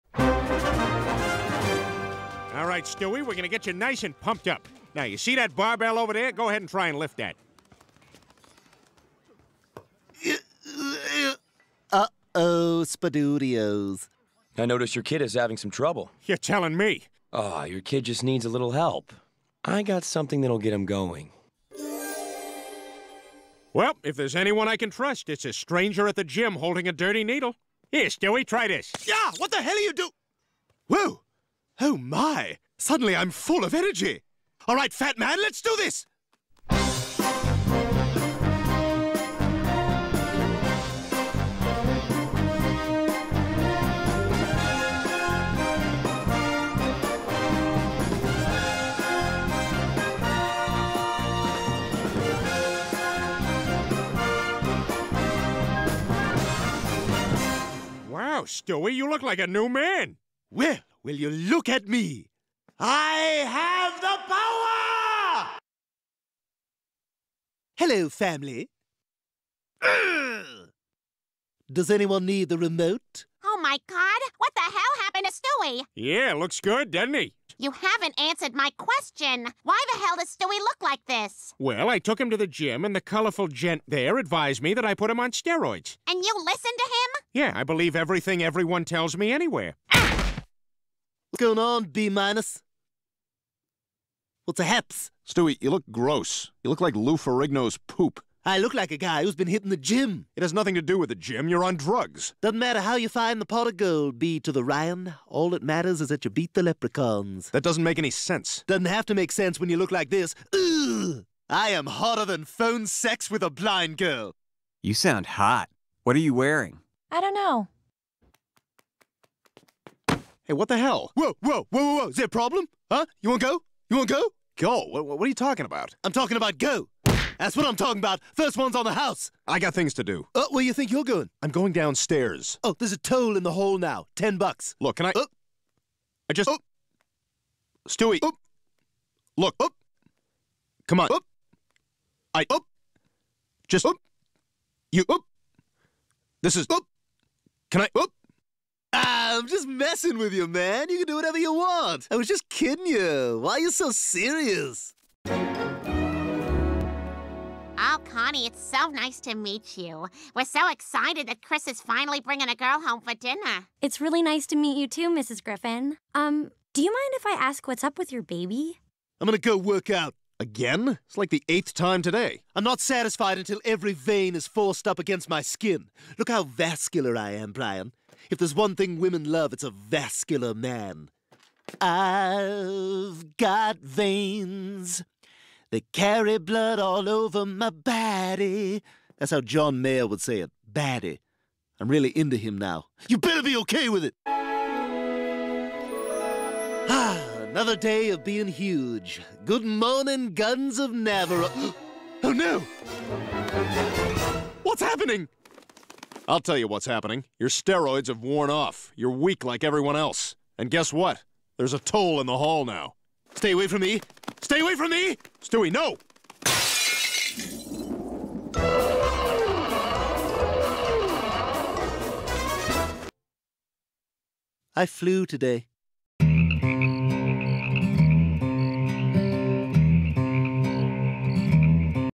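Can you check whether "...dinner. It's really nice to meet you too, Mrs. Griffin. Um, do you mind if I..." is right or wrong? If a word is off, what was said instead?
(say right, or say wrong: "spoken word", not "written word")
right.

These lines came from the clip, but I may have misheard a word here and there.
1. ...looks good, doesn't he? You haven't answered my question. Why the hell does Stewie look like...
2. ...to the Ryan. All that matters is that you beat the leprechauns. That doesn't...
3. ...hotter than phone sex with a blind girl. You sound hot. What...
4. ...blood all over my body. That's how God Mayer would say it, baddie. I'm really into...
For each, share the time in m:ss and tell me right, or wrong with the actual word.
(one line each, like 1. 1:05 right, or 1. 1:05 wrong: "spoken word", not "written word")
1. 1:16 right
2. 1:44 right
3. 1:51 right
4. 3:06 wrong: "John", not "God".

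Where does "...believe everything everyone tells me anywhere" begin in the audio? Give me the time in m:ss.
1:27.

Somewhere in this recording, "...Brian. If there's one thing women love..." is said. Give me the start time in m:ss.
2:57.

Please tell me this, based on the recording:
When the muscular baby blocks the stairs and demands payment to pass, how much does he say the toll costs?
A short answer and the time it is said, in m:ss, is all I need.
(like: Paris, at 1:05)
$10, at 2:14.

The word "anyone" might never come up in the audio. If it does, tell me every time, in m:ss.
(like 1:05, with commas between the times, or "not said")
0:24, 1:11.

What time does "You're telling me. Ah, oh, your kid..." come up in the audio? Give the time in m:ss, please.
0:16.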